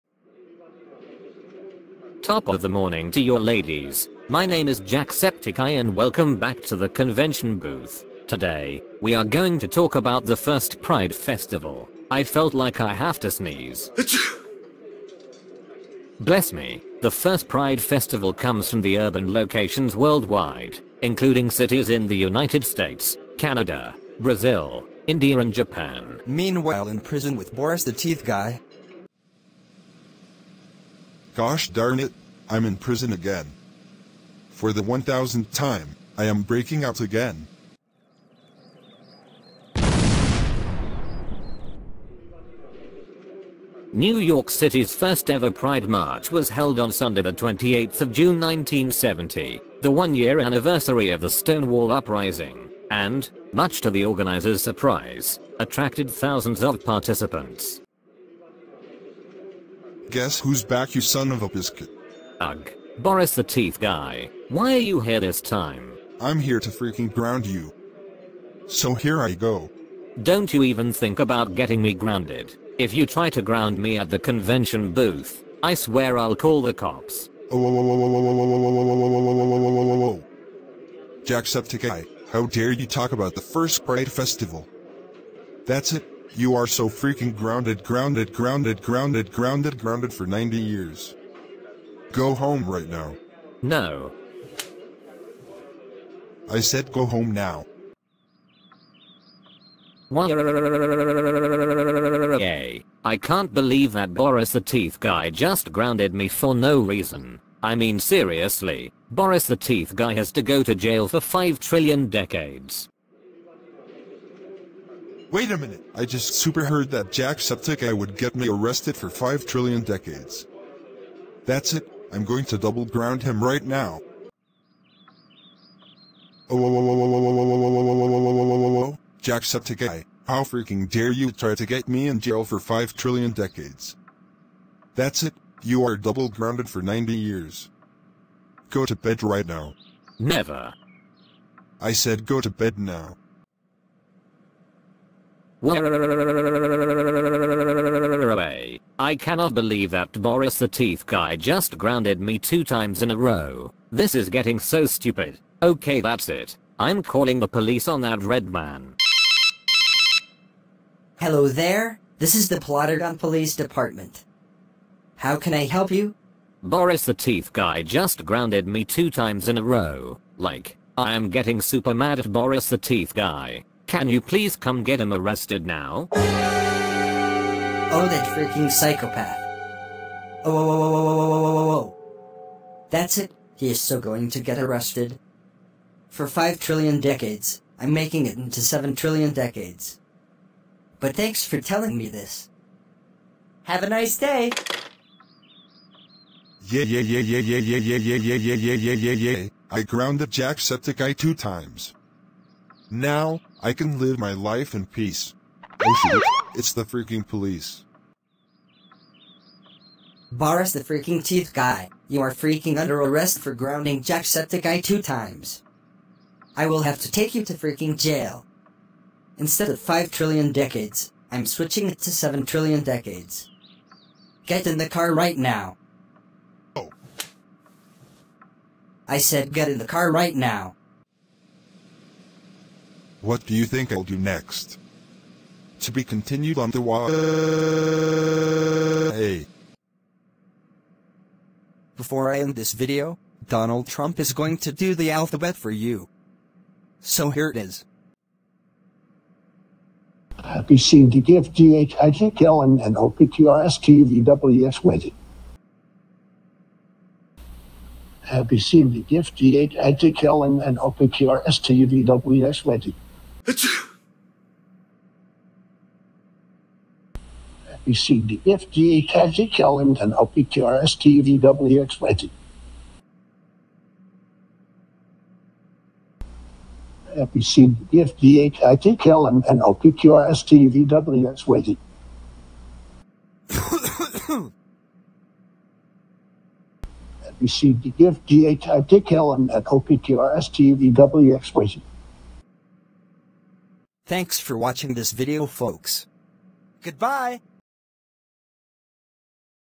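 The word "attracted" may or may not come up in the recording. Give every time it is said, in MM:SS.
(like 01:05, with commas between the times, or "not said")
00:55.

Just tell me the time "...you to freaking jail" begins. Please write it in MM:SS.
03:37.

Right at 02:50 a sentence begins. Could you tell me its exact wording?
Like, I am getting super mad at Boris the Teeth guy.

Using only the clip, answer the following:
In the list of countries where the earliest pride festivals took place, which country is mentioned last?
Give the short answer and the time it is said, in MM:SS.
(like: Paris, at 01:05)
Japan, at 00:25.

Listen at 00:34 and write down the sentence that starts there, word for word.
For the 1000th time, I am breaking out again.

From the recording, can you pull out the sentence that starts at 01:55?
Wait a minute, I just super heard that Jacksepticeye would get me arrested for 5 trillion decades.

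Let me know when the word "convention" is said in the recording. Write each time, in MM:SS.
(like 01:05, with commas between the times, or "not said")
00:06, 01:14.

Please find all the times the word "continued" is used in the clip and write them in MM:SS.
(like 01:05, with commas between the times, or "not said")
03:56.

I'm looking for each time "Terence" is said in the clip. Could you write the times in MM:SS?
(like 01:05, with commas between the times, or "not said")
not said.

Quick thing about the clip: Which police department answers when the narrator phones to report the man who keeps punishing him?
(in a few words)
Plotterdown Police Department.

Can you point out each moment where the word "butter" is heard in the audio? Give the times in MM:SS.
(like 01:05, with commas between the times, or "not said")
not said.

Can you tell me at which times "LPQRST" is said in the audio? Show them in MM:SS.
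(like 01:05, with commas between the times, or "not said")
04:39, 04:49.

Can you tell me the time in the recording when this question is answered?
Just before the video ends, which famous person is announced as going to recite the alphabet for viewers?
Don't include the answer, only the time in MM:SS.
04:03.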